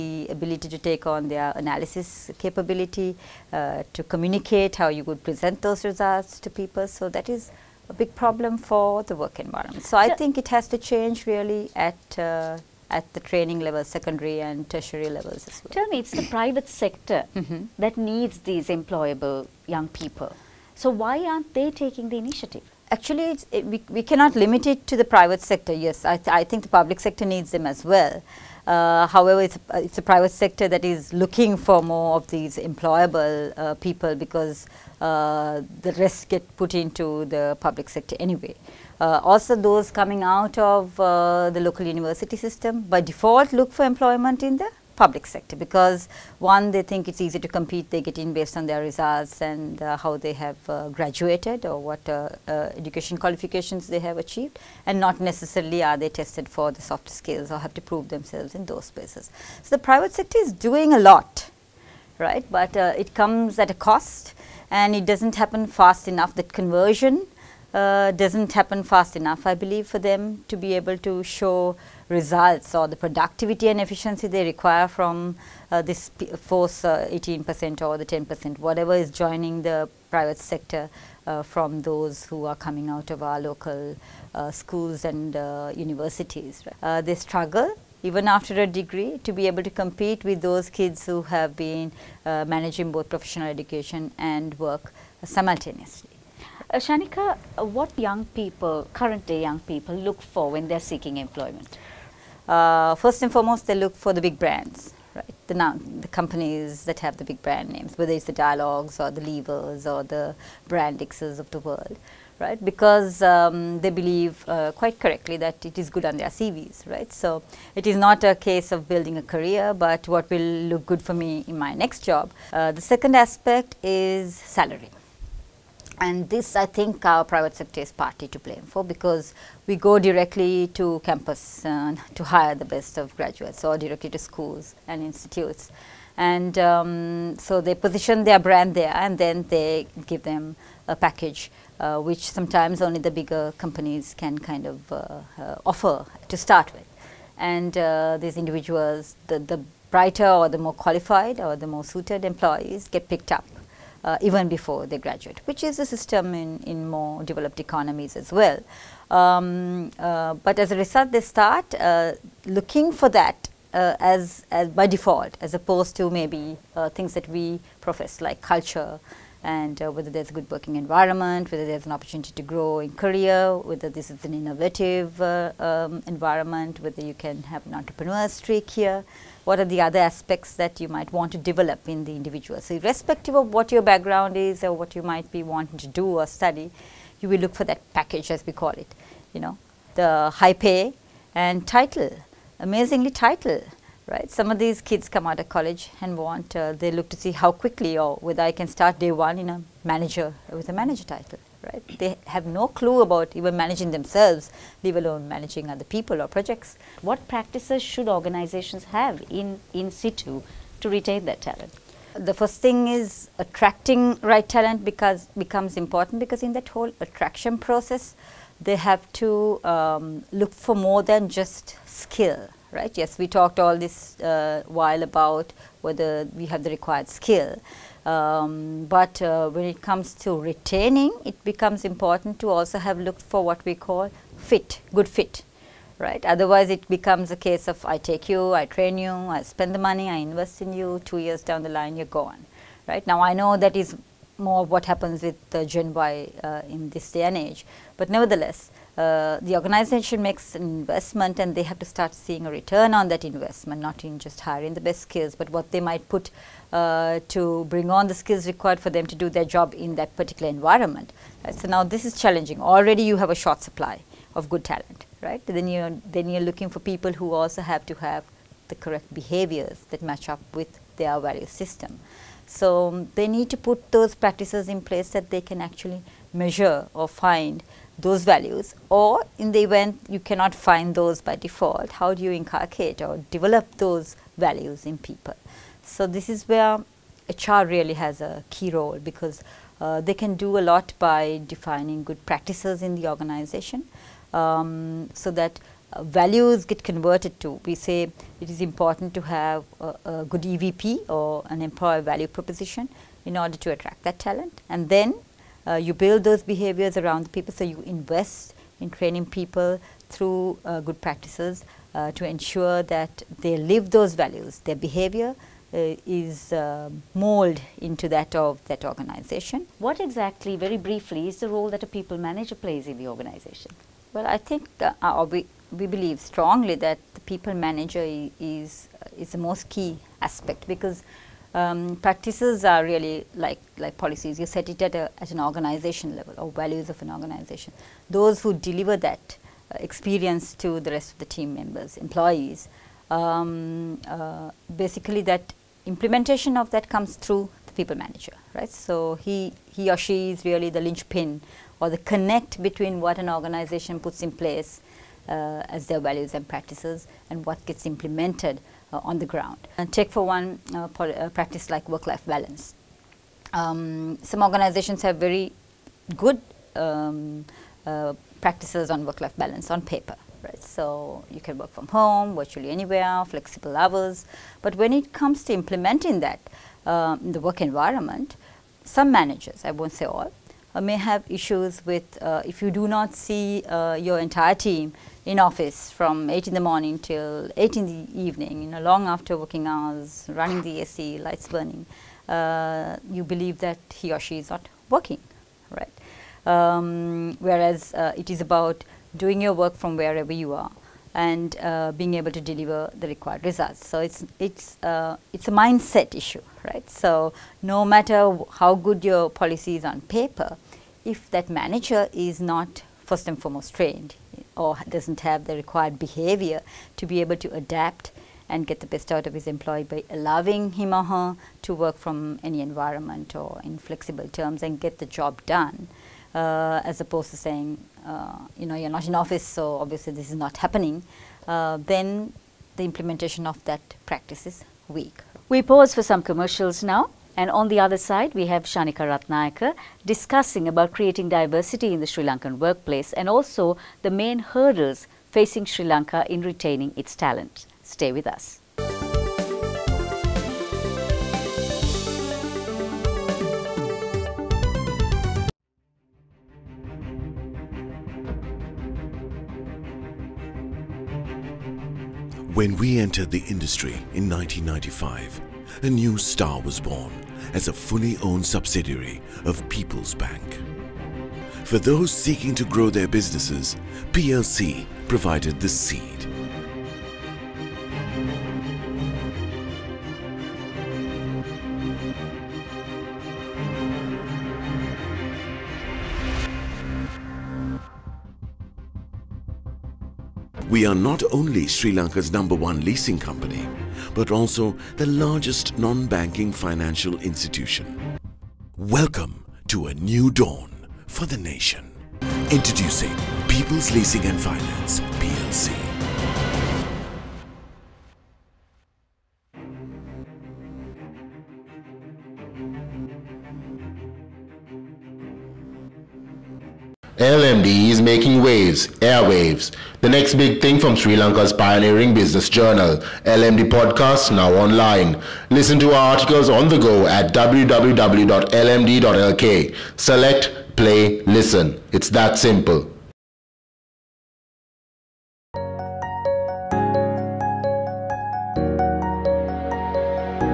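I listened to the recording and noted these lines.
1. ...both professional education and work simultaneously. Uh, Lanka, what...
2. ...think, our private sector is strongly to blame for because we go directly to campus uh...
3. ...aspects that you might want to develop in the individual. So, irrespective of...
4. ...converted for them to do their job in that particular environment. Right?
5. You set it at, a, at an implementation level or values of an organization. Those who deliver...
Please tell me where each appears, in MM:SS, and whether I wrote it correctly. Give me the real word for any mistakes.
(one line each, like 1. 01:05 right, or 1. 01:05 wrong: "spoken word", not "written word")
1. 01:32 wrong: "Kshanika", not "Lanka"
2. 02:06 wrong: "partly", not "strongly"
3. 02:59 right
4. 04:18 wrong: "required", not "converted"
5. 05:34 wrong: "organization", not "implementation".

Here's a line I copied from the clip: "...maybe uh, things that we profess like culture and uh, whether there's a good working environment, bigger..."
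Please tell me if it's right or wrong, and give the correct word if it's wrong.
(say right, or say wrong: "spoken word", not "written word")
wrong: "whether", not "bigger".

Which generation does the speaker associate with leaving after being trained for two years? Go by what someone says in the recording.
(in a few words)
Gen Y.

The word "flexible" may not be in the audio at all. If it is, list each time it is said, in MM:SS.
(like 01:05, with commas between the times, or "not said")
06:13, 07:03.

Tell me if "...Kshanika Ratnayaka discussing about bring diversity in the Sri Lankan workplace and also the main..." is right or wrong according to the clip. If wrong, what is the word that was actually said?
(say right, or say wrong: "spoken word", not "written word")
wrong: "creating", not "bring".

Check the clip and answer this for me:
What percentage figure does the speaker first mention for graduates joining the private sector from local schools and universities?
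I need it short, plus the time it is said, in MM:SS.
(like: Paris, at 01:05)
18%, at 01:16.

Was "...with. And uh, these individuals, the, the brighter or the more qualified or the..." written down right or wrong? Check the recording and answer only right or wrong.
right.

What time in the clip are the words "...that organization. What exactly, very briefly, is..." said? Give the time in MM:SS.
05:18.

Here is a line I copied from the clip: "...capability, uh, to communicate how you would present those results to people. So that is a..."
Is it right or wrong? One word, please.
right.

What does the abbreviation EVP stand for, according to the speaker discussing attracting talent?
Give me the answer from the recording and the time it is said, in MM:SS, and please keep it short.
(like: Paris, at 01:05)
Employer value proposition, at 05:01.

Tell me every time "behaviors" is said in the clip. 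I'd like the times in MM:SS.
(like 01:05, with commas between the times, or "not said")
04:29, 05:06, 05:14, 06:55.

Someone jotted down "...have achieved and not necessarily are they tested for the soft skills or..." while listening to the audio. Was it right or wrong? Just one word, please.
right.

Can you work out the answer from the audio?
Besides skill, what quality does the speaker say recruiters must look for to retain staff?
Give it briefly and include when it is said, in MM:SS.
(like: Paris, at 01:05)
Good fit, at 03:54.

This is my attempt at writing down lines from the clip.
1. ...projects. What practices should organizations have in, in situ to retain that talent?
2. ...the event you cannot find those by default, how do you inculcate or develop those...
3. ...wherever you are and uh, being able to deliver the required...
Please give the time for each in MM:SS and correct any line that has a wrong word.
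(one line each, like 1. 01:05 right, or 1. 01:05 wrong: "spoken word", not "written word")
1. 03:26 right
2. 04:39 right
3. 06:39 right.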